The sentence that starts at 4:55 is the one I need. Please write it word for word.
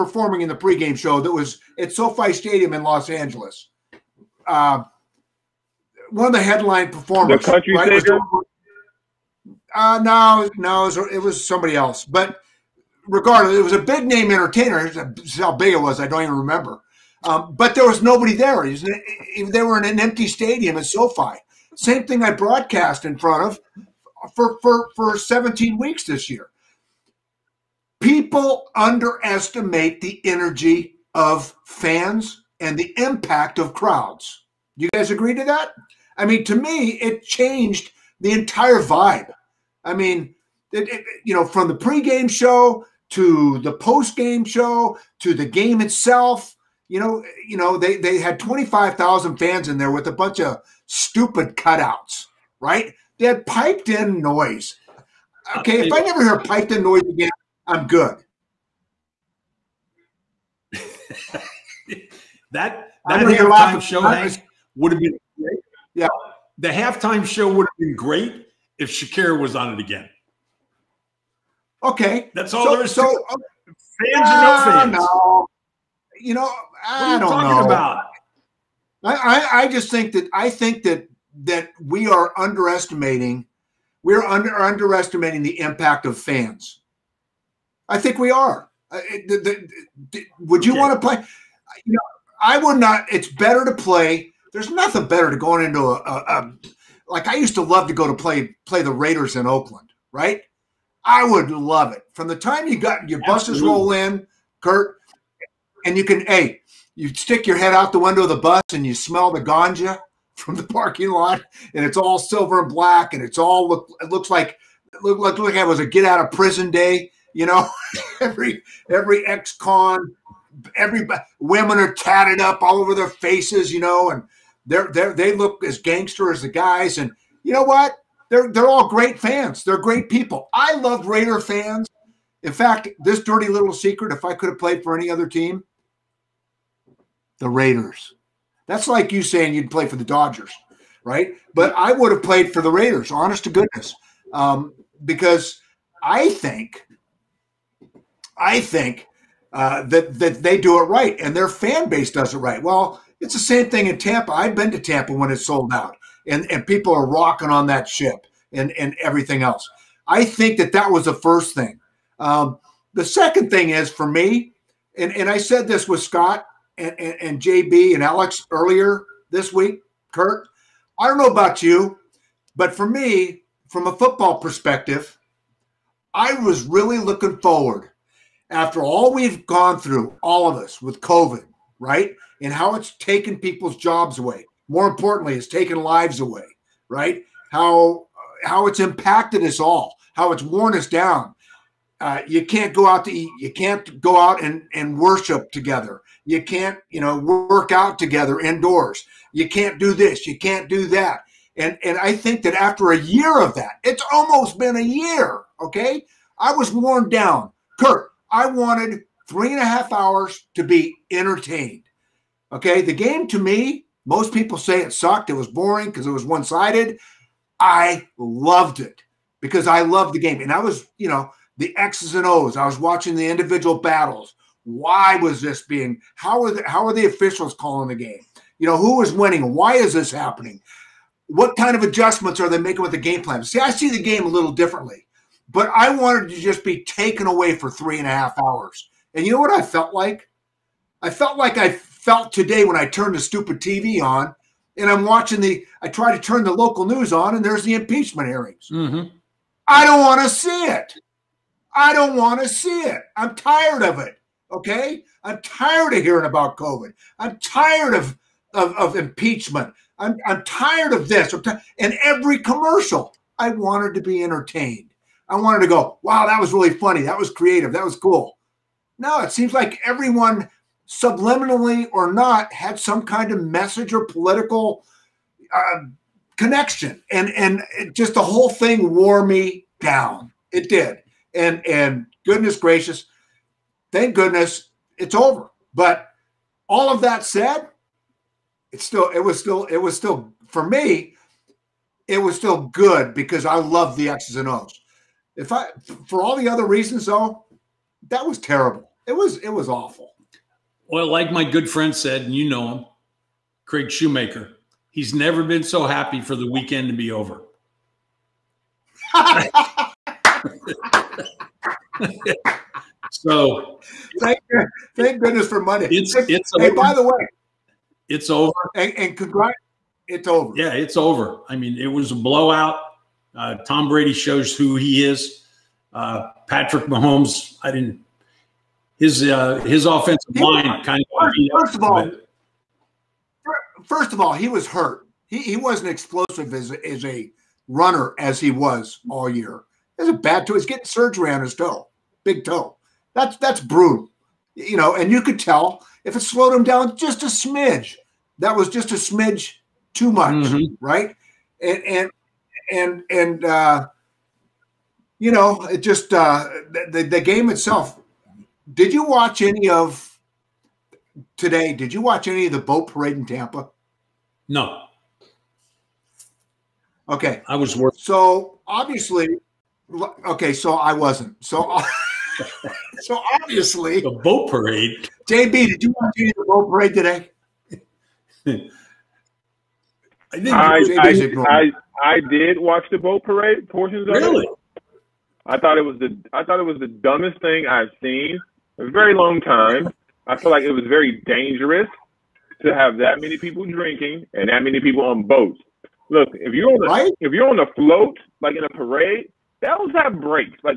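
If I for all the other reasons though, that was terrible.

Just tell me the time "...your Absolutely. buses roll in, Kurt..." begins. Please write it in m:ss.
1:43.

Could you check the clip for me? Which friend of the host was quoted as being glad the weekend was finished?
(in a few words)
Craig Shoemaker.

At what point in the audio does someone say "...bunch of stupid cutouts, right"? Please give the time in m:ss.
0:50.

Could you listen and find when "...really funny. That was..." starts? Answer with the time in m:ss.
4:26.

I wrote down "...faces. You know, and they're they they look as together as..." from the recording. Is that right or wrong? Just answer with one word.
wrong.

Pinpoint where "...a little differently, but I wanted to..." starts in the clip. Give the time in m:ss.
3:54.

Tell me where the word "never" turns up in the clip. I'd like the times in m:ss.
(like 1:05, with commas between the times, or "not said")
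0:55, 5:05.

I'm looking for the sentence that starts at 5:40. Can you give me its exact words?
He's getting surgery on his toe, big toe.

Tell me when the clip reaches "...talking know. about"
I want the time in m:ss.
1:17.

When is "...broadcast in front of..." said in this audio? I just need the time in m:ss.
0:22.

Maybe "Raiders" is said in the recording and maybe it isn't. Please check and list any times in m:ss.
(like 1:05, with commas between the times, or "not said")
1:38, 2:11, 2:17, 2:22.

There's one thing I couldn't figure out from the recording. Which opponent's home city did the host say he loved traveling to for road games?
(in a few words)
Oakland.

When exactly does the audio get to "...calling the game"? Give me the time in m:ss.
3:47.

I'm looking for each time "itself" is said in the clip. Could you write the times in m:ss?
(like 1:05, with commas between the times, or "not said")
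0:45, 5:57.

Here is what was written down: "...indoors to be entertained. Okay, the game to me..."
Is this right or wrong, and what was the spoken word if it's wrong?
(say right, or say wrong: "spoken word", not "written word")
wrong: "hours", not "indoors".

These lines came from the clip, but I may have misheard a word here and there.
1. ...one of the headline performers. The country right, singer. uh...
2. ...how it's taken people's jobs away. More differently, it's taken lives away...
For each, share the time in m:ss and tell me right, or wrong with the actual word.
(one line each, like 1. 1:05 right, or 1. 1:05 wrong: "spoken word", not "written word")
1. 0:06 right
2. 3:02 wrong: "importantly", not "differently".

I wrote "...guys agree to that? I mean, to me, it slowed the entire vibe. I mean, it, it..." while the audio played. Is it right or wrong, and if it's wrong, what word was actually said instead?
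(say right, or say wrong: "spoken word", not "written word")
wrong: "changed", not "slowed".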